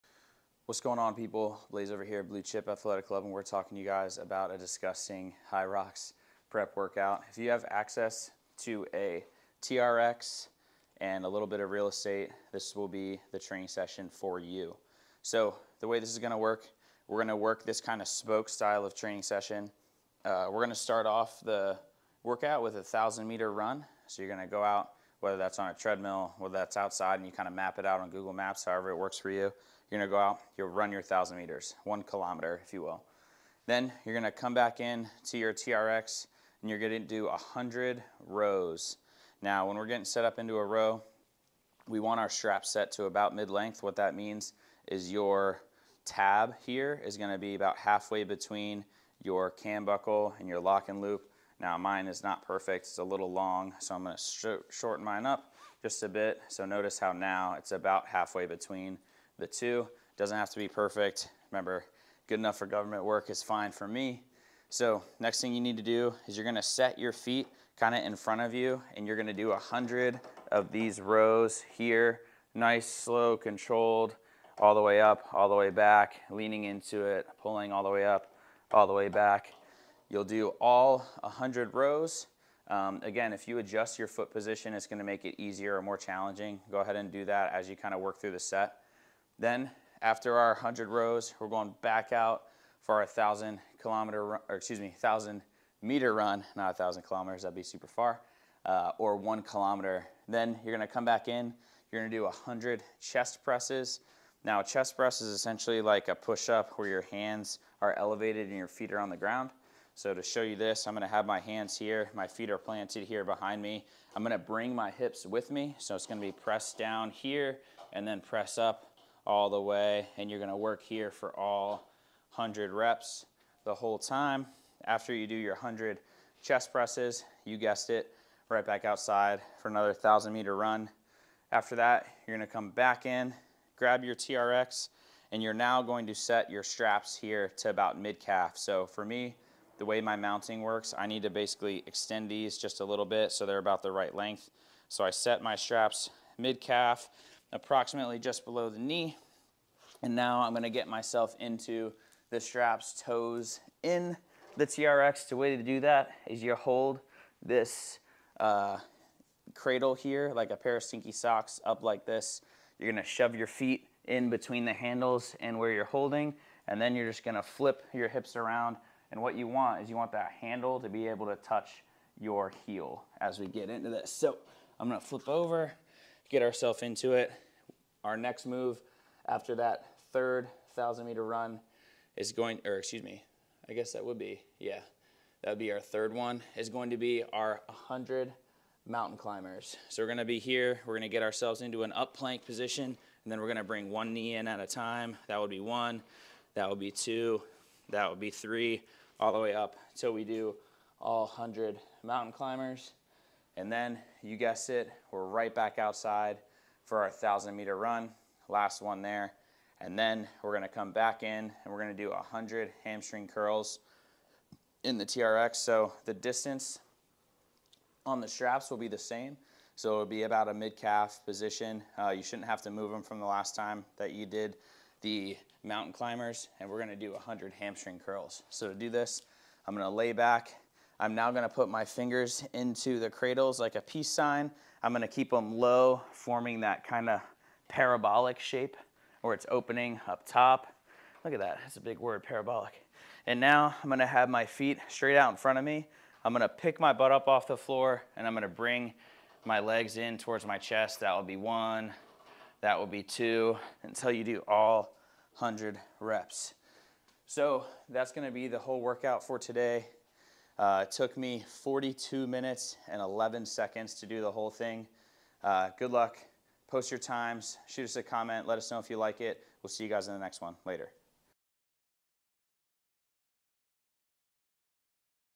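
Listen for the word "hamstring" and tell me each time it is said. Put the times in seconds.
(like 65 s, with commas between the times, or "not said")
212 s, 227 s.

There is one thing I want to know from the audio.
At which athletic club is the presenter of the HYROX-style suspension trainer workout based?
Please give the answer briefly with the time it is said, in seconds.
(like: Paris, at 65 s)
Blue Chip Athletic Club, at 2 s.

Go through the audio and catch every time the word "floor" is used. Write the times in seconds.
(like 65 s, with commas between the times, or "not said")
247 s.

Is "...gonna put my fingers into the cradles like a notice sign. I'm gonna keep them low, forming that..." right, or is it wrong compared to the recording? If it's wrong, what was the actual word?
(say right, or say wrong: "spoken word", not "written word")
wrong: "peace", not "notice".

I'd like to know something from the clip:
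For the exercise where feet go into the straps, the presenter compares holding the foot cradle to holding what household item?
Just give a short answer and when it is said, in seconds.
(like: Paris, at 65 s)
a pair of stinky socks, at 160 s.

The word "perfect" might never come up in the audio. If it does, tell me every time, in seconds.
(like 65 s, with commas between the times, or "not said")
52 s, 60 s.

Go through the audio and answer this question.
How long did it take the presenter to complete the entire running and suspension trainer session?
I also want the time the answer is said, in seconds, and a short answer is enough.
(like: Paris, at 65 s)
42 minutes and 11 seconds, at 261 s.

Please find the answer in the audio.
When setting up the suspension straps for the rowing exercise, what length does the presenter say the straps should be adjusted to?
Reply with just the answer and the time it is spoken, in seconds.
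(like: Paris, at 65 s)
mid-length, at 43 s.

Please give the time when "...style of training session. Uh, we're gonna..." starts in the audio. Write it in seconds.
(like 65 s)
18 s.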